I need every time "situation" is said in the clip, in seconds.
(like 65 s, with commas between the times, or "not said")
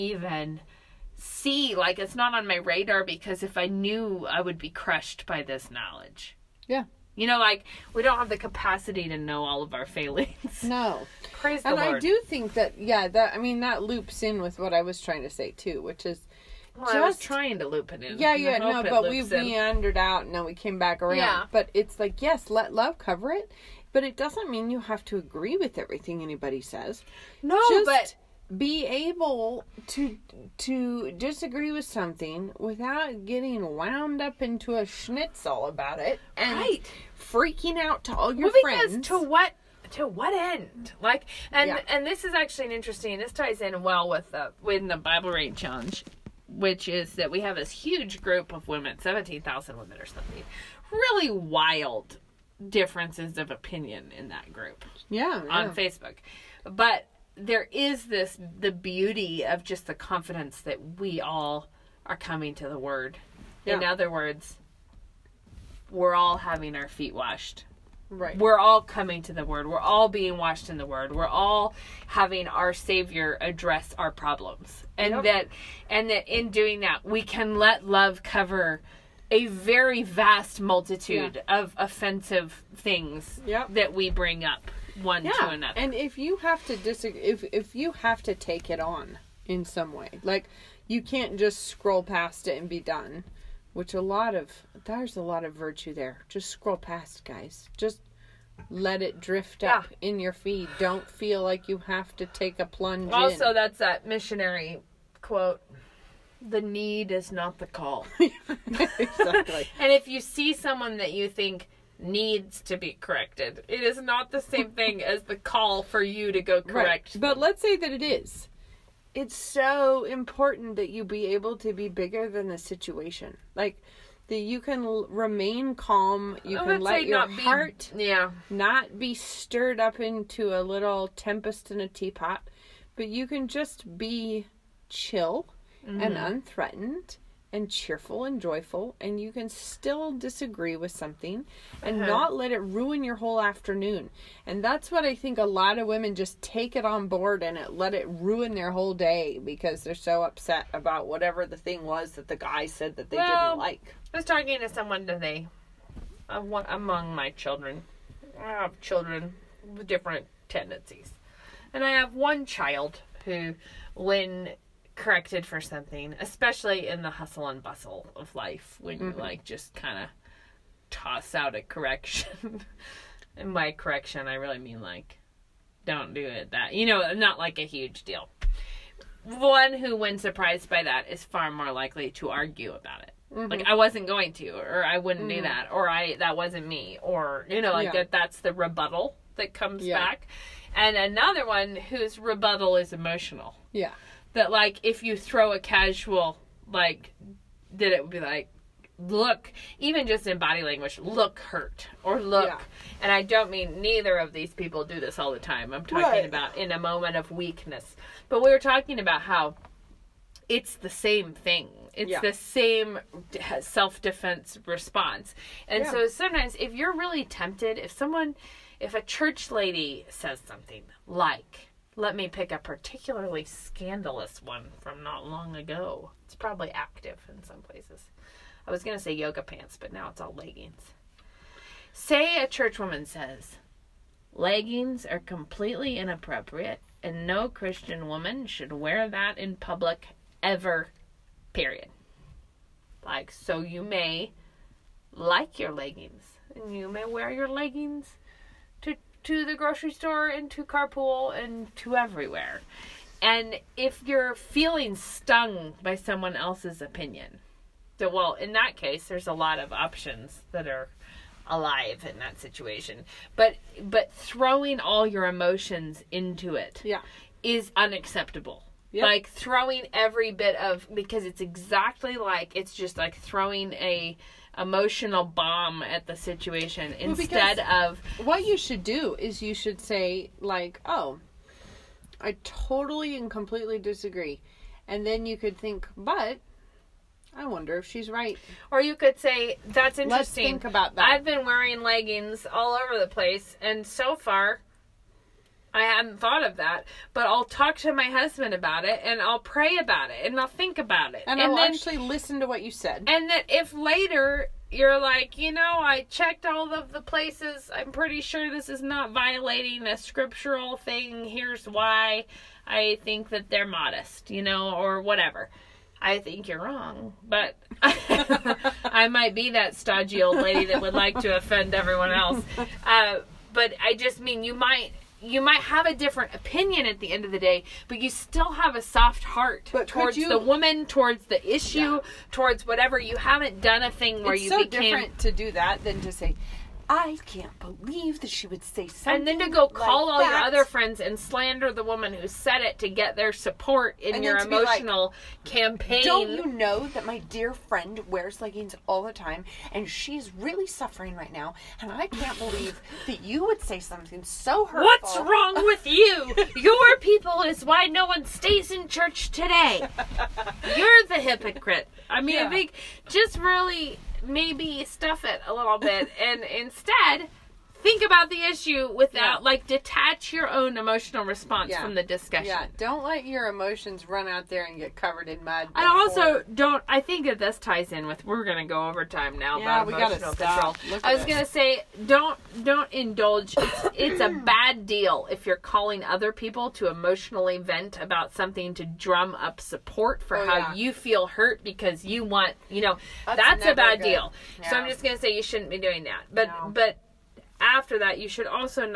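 122 s, 262 s, 276 s.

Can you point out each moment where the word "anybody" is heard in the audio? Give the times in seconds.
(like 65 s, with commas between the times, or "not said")
26 s.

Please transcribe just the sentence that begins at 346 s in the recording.
Don't you know that my dear friend wears leggings all the time and she's really suffering right now?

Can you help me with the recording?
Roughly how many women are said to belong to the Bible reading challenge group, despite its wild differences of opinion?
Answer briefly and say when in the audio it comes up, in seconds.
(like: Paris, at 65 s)
17,000, at 48 s.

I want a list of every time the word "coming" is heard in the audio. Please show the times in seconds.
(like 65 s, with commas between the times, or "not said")
62 s, 68 s.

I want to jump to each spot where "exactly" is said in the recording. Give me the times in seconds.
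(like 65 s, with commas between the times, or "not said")
108 s, 271 s.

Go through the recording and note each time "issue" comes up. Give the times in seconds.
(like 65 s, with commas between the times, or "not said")
331 s, 368 s.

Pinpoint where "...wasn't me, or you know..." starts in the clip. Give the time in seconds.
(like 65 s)
186 s.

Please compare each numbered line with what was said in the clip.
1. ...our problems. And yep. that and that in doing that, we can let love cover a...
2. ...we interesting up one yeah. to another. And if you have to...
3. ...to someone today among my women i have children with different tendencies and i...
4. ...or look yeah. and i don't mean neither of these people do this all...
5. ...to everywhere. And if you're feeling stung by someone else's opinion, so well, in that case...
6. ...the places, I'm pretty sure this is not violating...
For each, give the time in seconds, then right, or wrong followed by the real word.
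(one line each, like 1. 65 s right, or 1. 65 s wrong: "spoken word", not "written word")
1. 73 s right
2. 83 s wrong: "bring", not "interesting"
3. 154 s wrong: "children", not "women"
4. 202 s right
5. 251 s right
6. 306 s right.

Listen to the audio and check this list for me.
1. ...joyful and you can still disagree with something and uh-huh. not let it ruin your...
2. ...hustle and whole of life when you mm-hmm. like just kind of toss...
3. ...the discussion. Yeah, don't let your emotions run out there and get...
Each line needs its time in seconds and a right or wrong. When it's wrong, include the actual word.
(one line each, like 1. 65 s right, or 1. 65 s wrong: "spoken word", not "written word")
1. 138 s right
2. 167 s wrong: "bustle", not "whole"
3. 371 s right.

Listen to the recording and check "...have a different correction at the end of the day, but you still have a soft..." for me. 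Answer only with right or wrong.
wrong.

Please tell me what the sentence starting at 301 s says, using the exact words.
And, and I'll then, actually listen to what you said.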